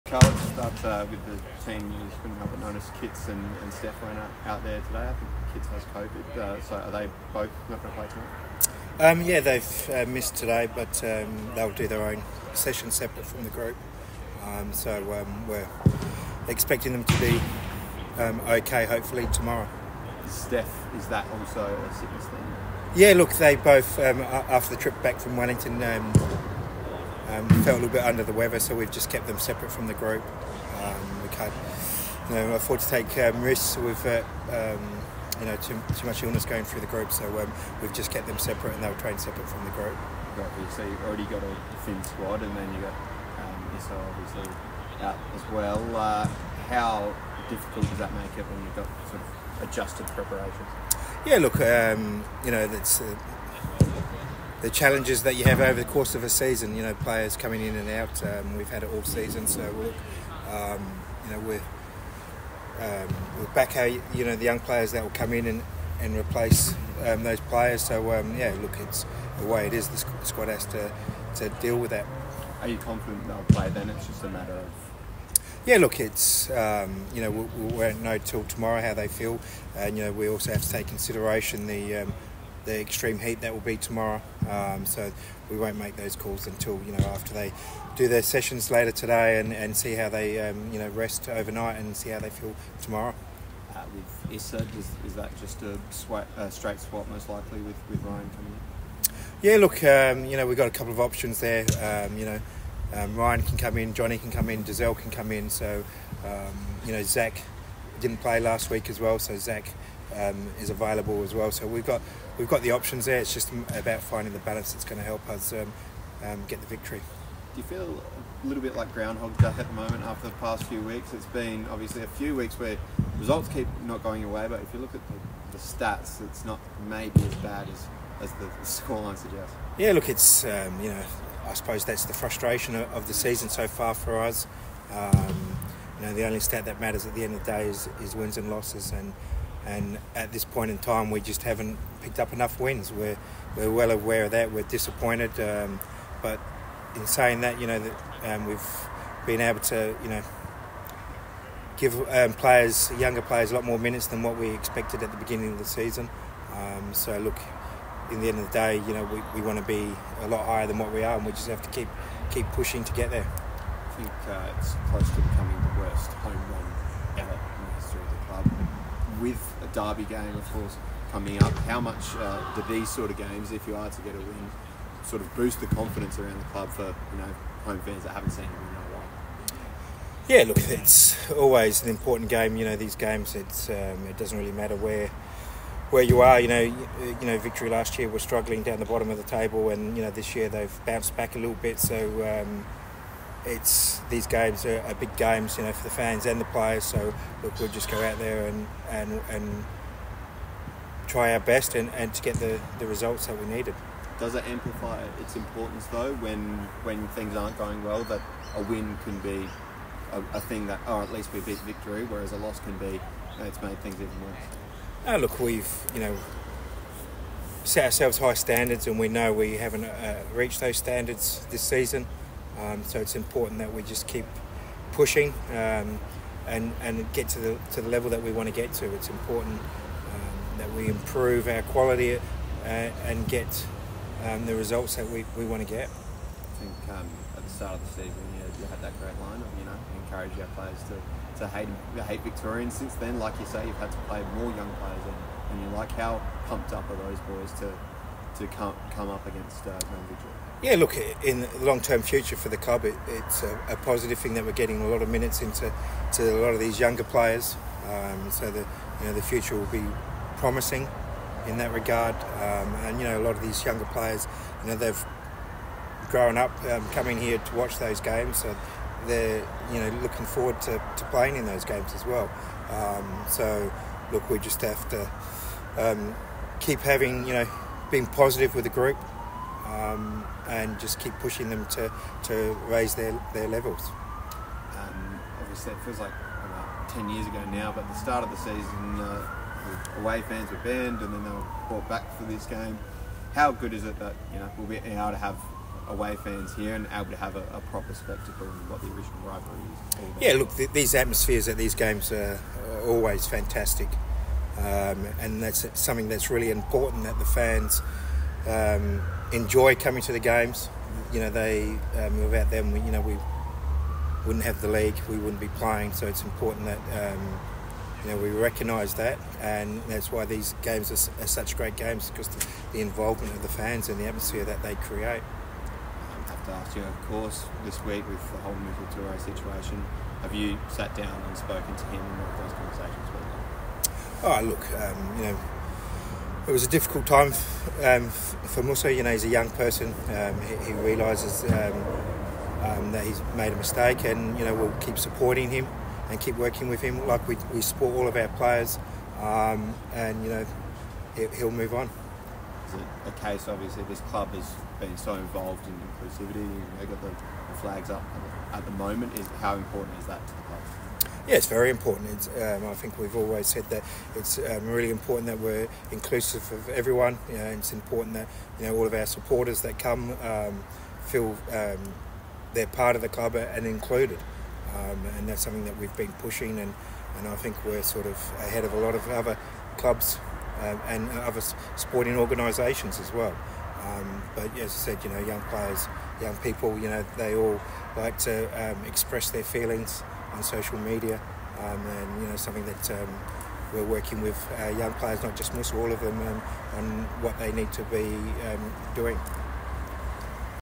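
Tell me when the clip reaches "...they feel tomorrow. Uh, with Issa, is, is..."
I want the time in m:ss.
1:32.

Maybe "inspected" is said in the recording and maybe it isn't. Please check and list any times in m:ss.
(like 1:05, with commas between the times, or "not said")
not said.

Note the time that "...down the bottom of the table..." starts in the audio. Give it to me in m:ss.
3:08.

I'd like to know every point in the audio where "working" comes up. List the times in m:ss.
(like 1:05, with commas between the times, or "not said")
5:46, 6:33.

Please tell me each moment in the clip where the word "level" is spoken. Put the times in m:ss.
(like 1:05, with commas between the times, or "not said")
3:47, 4:43.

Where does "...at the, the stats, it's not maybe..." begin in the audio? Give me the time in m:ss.
2:04.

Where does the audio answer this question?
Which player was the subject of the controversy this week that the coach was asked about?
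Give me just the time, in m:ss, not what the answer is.
5:28.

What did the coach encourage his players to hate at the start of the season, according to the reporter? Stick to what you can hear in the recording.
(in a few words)
Victorians.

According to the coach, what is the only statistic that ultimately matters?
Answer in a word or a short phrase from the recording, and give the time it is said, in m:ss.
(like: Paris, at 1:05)
Wins and losses, at 2:18.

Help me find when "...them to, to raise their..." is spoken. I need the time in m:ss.
4:41.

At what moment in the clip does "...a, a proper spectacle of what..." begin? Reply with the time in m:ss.
4:57.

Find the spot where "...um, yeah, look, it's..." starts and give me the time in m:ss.
1:08.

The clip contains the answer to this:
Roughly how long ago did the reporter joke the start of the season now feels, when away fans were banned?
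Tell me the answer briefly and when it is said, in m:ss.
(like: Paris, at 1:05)
10 years, at 4:46.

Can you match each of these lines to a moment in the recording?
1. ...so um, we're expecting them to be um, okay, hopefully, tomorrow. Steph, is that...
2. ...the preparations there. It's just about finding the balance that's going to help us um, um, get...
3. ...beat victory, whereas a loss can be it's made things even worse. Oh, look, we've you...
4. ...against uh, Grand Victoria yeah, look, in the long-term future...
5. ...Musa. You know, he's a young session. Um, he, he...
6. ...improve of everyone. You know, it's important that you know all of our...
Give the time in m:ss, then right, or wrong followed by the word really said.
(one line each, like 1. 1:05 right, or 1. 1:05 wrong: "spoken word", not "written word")
1. 0:14 right
2. 1:52 wrong: "options", not "preparations"
3. 3:31 right
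4. 4:09 right
5. 5:38 wrong: "person", not "session"
6. 6:05 wrong: "inclusive", not "improve".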